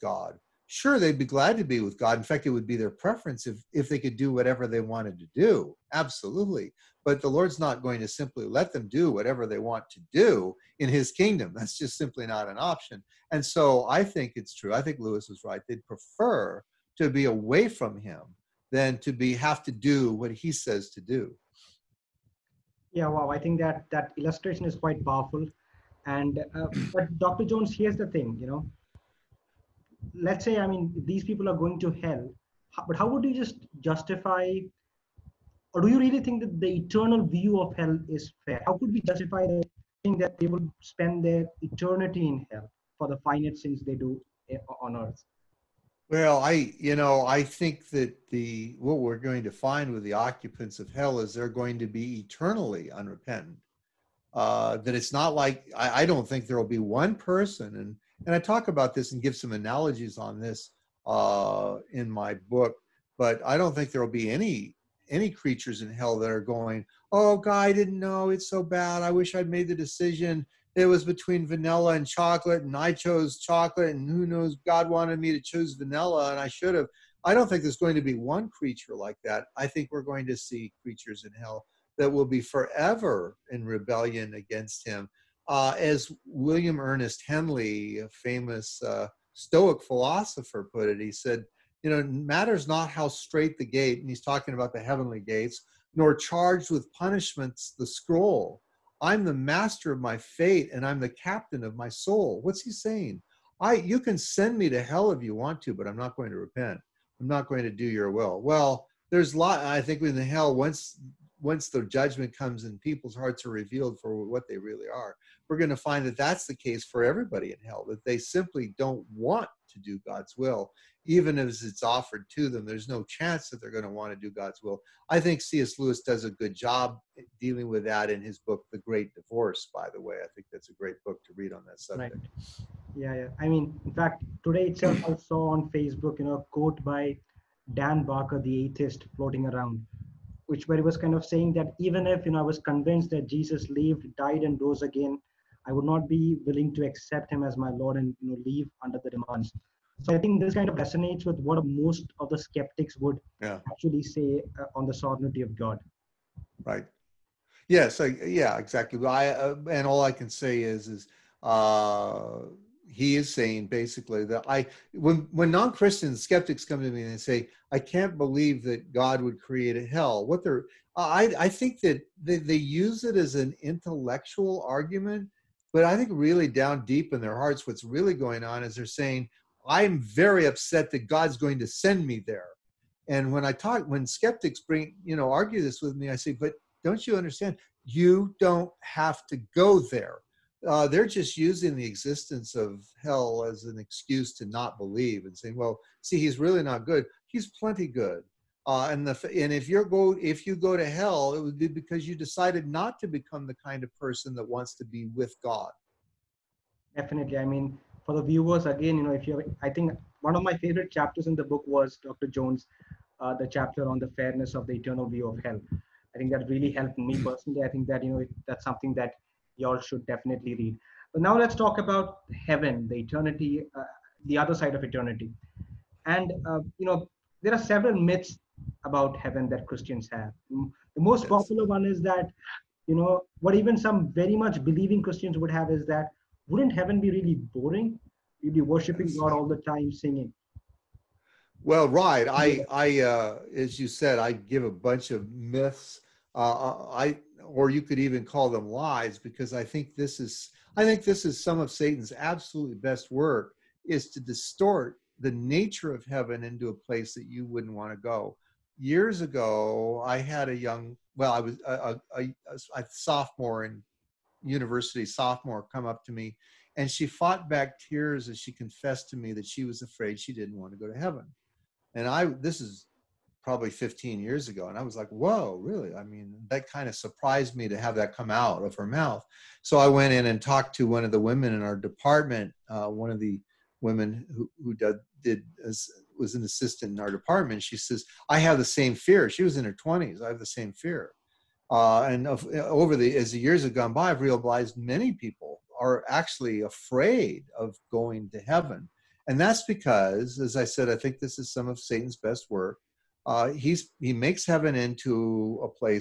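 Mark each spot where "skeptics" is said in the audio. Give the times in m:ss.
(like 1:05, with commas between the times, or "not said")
2:32, 2:46, 3:04.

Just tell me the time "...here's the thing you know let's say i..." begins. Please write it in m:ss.
0:27.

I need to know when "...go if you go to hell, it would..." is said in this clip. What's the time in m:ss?
3:19.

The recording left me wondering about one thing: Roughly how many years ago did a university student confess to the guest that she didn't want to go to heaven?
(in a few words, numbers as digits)
15.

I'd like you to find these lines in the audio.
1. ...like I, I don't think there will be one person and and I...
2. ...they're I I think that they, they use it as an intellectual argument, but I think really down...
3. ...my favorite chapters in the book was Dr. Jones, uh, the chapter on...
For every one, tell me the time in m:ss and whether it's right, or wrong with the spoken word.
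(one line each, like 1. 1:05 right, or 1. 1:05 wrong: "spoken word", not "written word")
1. 0:55 right
2. 2:50 right
3. 3:30 right.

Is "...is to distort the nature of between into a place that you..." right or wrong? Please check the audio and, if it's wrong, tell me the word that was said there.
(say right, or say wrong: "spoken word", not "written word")
wrong: "heaven", not "between".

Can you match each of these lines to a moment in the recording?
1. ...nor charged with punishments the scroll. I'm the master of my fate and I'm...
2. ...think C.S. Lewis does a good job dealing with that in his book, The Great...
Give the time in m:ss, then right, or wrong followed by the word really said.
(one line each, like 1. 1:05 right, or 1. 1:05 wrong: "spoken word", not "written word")
1. 1:35 right
2. 2:05 right.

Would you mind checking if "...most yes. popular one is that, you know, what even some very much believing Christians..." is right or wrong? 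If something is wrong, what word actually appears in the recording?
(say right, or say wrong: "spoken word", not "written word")
right.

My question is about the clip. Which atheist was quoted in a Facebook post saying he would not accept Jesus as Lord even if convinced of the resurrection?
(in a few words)
Dan Barker.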